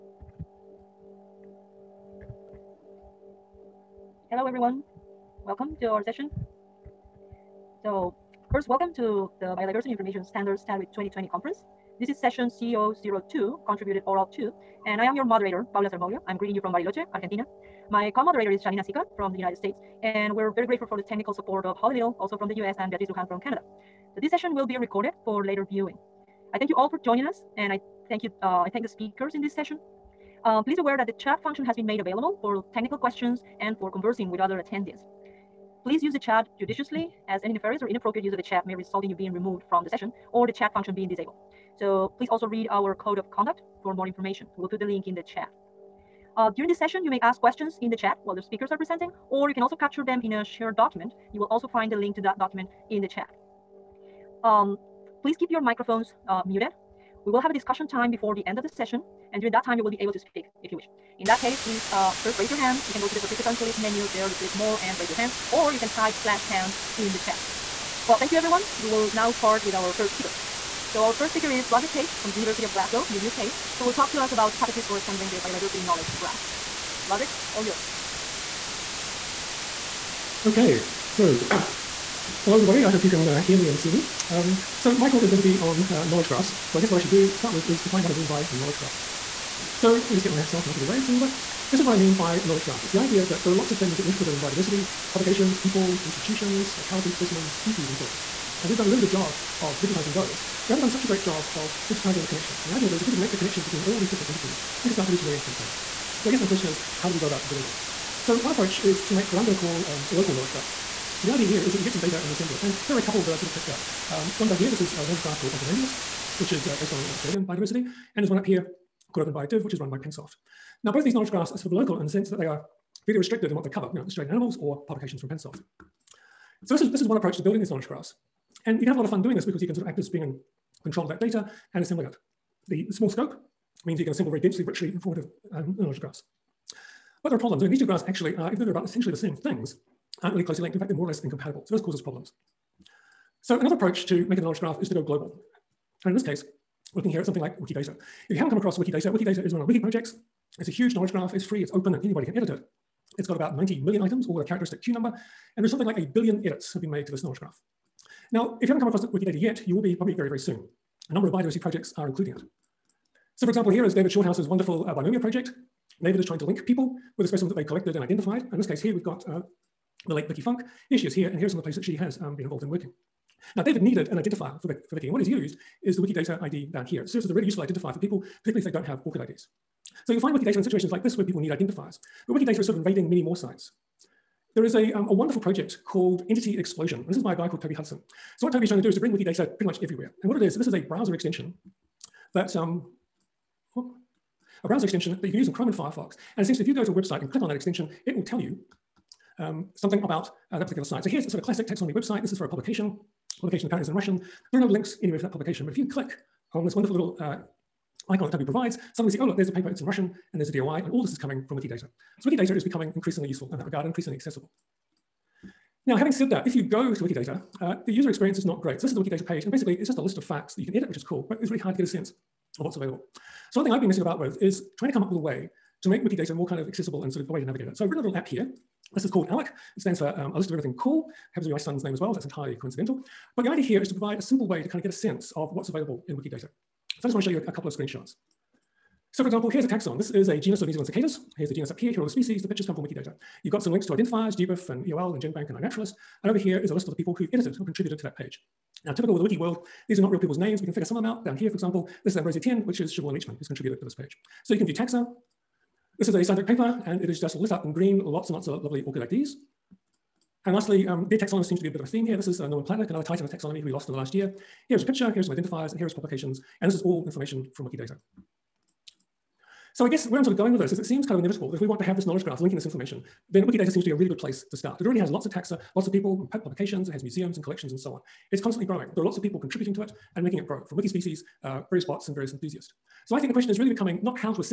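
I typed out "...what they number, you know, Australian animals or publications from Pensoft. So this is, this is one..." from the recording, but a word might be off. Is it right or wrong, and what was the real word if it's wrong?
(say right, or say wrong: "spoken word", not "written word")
wrong: "cover", not "number".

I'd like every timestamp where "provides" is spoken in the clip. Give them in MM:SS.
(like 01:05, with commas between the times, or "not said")
03:28, 03:53.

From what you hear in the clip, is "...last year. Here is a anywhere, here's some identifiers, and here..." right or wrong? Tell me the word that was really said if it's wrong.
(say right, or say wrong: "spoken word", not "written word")
wrong: "picture", not "anywhere".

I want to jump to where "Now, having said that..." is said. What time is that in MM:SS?
03:35.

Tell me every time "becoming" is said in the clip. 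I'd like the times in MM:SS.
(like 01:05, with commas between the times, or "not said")
03:32, 04:43.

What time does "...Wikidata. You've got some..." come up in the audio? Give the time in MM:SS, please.
04:02.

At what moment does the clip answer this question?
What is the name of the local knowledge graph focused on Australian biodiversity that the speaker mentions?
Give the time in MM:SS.
01:55.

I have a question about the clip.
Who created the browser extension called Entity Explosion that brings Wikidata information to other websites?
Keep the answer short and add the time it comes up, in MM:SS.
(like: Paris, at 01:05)
Toby Hudson, at 03:07.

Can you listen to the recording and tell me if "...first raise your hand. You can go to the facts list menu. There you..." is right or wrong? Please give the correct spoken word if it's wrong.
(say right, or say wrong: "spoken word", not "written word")
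wrong: "participants", not "facts".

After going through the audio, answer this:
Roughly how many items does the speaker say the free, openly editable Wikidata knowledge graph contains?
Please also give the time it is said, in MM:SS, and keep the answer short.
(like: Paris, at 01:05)
90 million, at 02:33.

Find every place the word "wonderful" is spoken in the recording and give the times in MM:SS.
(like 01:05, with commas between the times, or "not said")
02:44, 03:05, 03:26.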